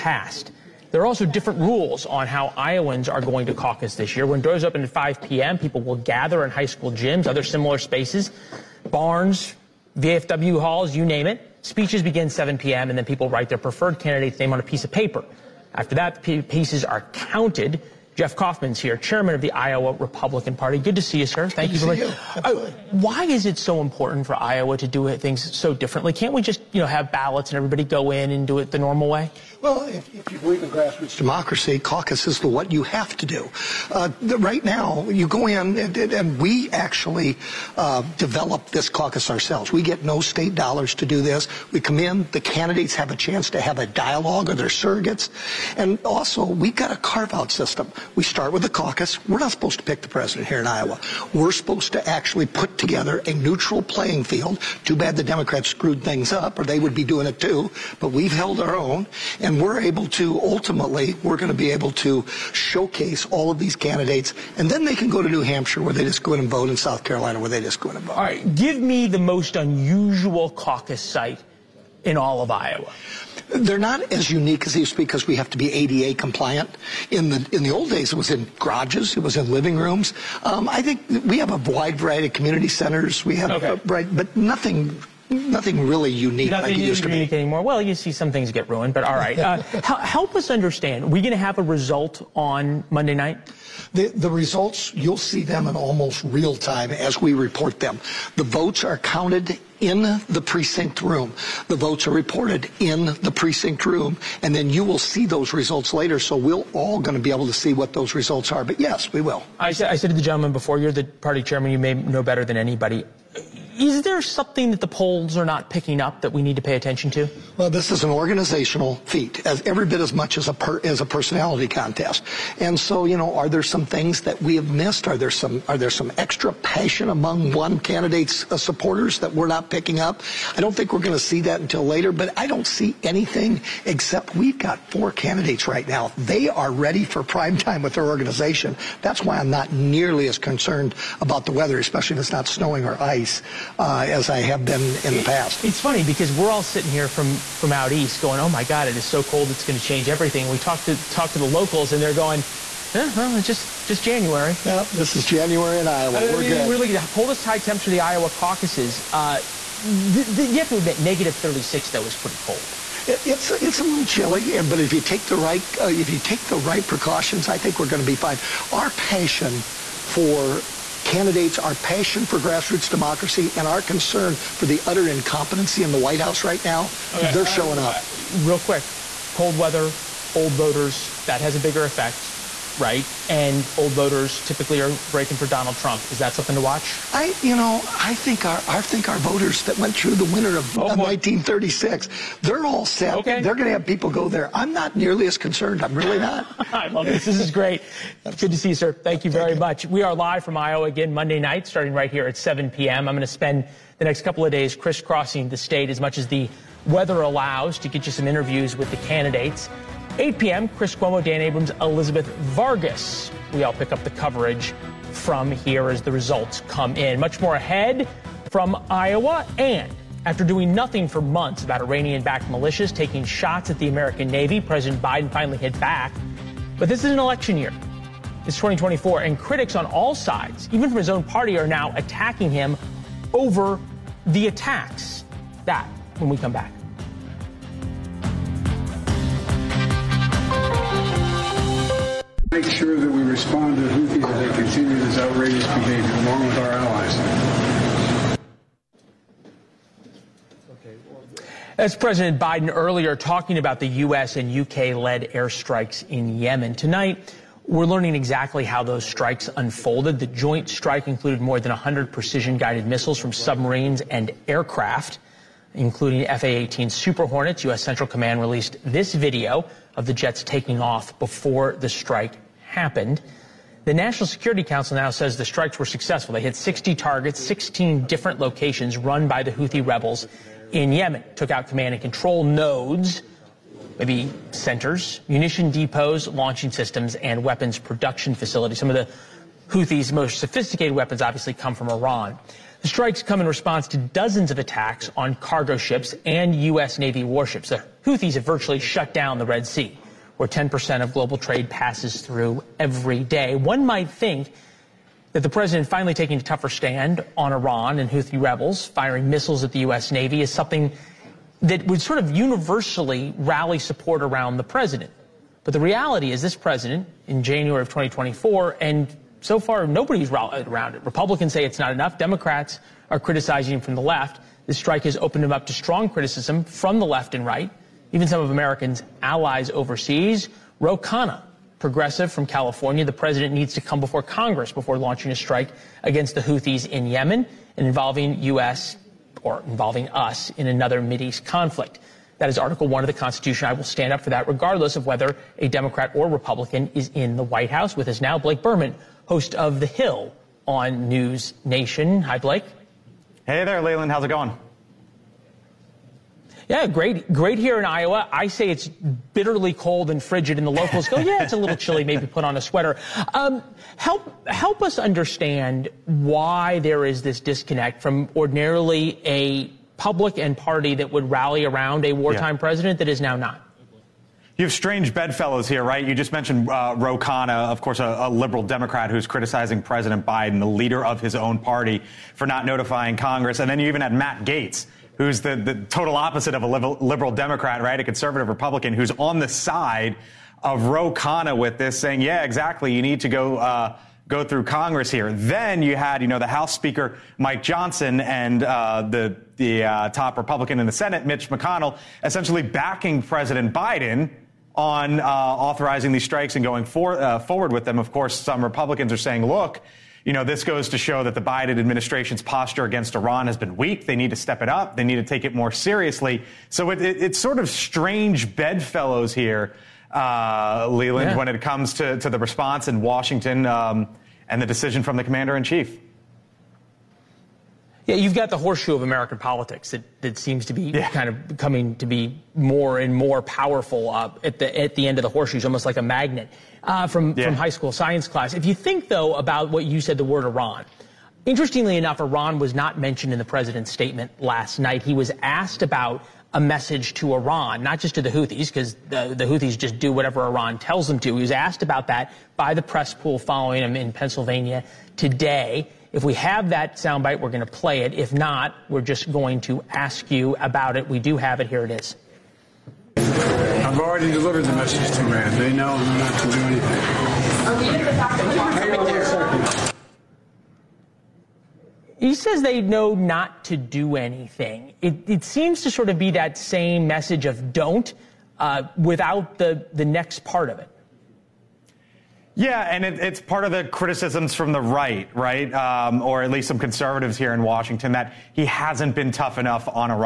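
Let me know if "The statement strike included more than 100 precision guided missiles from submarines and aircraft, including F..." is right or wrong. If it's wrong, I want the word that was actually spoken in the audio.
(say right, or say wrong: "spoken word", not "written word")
wrong: "joint", not "statement".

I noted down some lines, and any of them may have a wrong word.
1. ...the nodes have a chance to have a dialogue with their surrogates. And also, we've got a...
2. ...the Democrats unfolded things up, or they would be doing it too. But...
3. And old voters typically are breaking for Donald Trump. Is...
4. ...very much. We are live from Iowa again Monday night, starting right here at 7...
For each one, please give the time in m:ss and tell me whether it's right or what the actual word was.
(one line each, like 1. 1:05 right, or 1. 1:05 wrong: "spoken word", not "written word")
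1. 0:42 wrong: "candidates", not "nodes"
2. 0:55 wrong: "screwed", not "unfolded"
3. 3:03 right
4. 3:19 right.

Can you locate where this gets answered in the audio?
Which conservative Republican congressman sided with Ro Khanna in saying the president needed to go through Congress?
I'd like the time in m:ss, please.
6:24.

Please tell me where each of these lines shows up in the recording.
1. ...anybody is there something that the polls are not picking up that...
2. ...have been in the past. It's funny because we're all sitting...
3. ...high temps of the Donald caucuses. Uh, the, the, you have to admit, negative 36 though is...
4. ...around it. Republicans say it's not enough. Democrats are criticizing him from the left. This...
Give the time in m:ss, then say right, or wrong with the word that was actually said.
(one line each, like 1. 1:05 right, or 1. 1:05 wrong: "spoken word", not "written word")
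1. 1:52 right
2. 2:24 right
3. 2:37 wrong: "Iowa", not "Donald"
4. 5:20 right.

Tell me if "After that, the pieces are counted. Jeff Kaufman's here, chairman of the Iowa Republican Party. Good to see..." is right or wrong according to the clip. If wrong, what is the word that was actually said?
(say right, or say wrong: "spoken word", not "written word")
right.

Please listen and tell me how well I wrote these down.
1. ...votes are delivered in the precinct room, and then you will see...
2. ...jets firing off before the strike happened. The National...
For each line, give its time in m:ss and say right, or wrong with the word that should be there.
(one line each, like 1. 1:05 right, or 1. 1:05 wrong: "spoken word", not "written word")
1. 1:41 wrong: "reported", not "delivered"
2. 4:30 wrong: "taking", not "firing".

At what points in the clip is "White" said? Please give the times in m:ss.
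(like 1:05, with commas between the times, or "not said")
2:55, 5:47.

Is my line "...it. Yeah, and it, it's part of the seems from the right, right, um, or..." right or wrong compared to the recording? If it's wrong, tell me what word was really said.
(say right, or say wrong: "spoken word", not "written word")
wrong: "criticisms", not "seems".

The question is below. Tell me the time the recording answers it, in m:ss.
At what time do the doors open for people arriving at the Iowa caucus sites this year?
0:04.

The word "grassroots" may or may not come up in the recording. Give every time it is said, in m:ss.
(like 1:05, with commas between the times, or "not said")
0:30, 2:52.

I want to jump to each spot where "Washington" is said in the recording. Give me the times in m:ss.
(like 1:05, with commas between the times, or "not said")
7:03, 8:07.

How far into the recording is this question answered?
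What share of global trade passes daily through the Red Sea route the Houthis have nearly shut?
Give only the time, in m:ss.
5:00.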